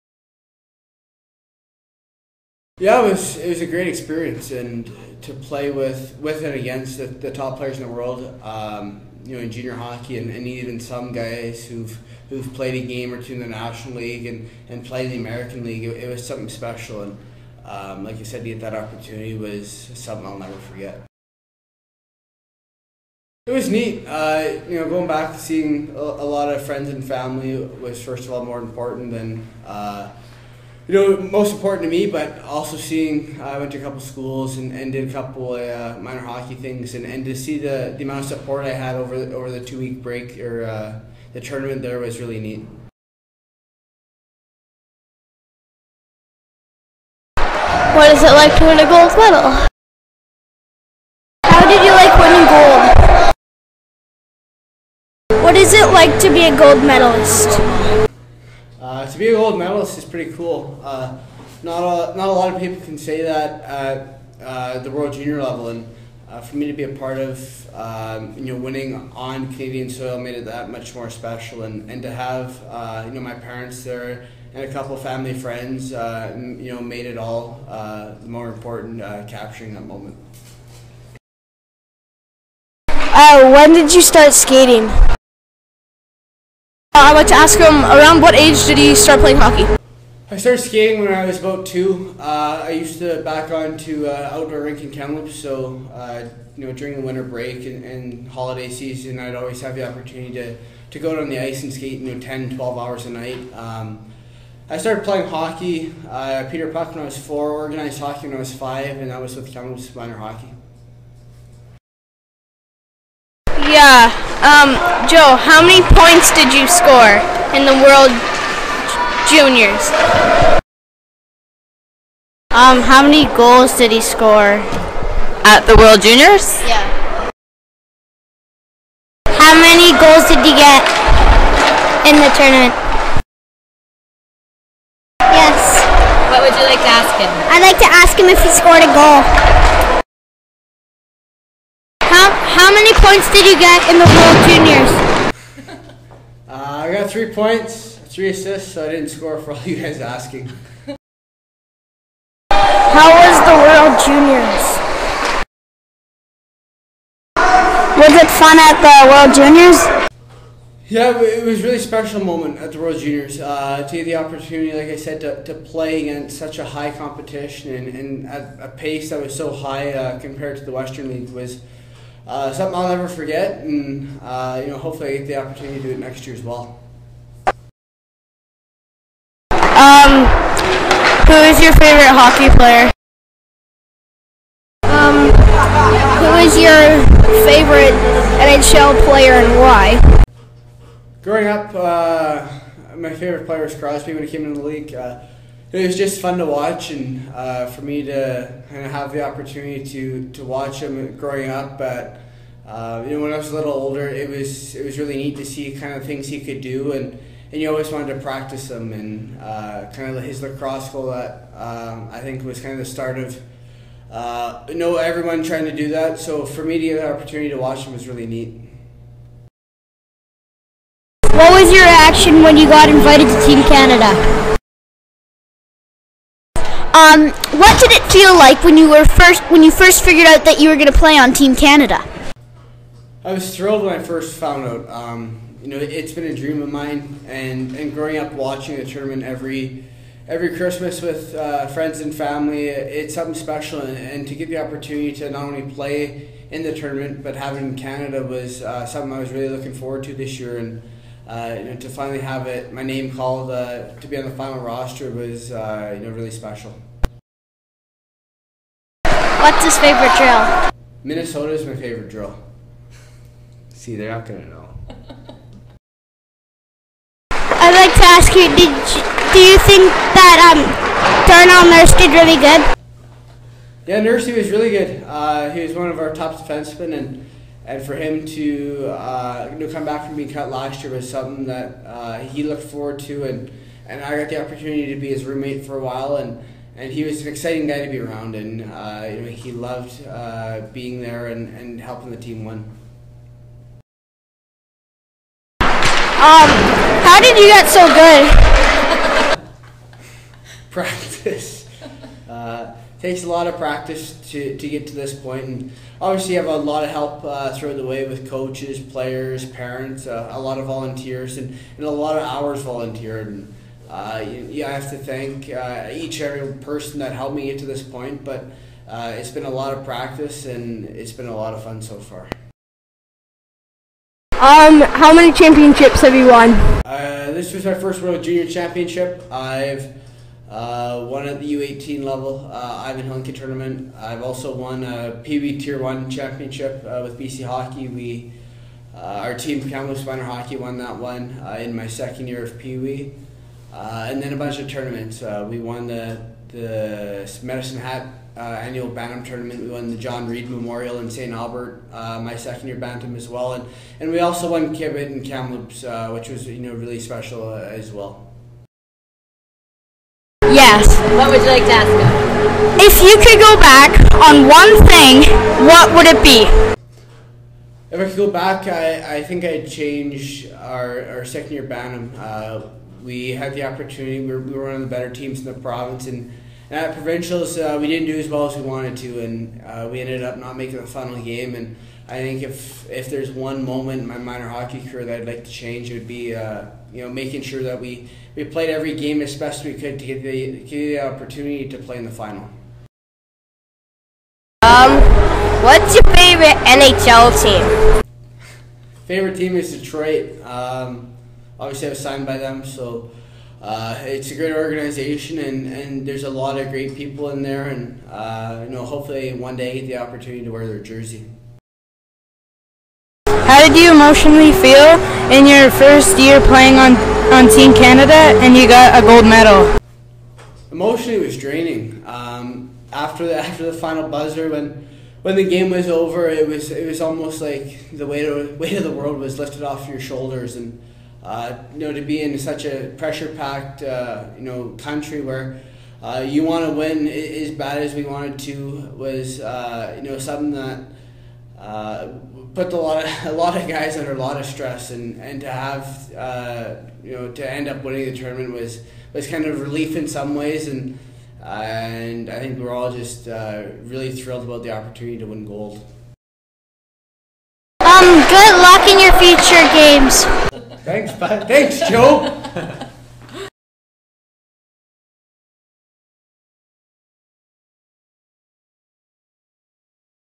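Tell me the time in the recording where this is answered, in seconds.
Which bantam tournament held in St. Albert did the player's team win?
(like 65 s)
349 s.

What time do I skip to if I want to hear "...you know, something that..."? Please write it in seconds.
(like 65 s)
440 s.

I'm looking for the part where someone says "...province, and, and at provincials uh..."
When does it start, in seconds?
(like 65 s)
375 s.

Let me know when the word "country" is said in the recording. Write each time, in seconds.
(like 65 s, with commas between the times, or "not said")
434 s.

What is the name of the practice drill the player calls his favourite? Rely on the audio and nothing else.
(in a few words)
Minnesota.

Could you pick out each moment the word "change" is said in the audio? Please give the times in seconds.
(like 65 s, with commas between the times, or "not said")
369 s, 385 s.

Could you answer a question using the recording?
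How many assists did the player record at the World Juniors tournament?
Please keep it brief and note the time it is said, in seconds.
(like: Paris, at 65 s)
3, at 148 s.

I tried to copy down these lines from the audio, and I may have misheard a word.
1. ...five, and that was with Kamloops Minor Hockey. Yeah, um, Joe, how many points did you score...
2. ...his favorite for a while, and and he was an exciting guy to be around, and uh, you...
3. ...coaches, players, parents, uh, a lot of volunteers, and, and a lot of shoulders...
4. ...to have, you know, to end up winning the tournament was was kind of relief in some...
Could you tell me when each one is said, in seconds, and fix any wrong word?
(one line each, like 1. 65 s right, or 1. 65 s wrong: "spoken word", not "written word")
1. 108 s right
2. 285 s wrong: "roommate", not "favorite"
3. 308 s wrong: "hours", not "shoulders"
4. 445 s right.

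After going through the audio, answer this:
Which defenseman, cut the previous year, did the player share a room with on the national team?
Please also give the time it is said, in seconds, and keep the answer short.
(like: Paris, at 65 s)
Darnell Nurse, at 271 s.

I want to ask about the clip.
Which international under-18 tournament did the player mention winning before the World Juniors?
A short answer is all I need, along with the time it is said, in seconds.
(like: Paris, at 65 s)
Ivan Hlinka, at 332 s.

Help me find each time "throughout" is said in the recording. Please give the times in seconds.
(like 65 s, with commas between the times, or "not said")
307 s.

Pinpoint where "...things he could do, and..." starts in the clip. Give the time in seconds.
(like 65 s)
206 s.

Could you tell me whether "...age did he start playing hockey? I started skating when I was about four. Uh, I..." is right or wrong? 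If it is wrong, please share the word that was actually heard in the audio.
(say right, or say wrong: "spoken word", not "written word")
wrong: "two", not "four".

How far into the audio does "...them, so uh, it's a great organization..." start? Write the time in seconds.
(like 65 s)
402 s.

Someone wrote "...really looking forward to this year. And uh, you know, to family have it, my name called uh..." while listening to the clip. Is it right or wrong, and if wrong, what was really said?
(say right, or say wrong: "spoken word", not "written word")
wrong: "finally", not "family".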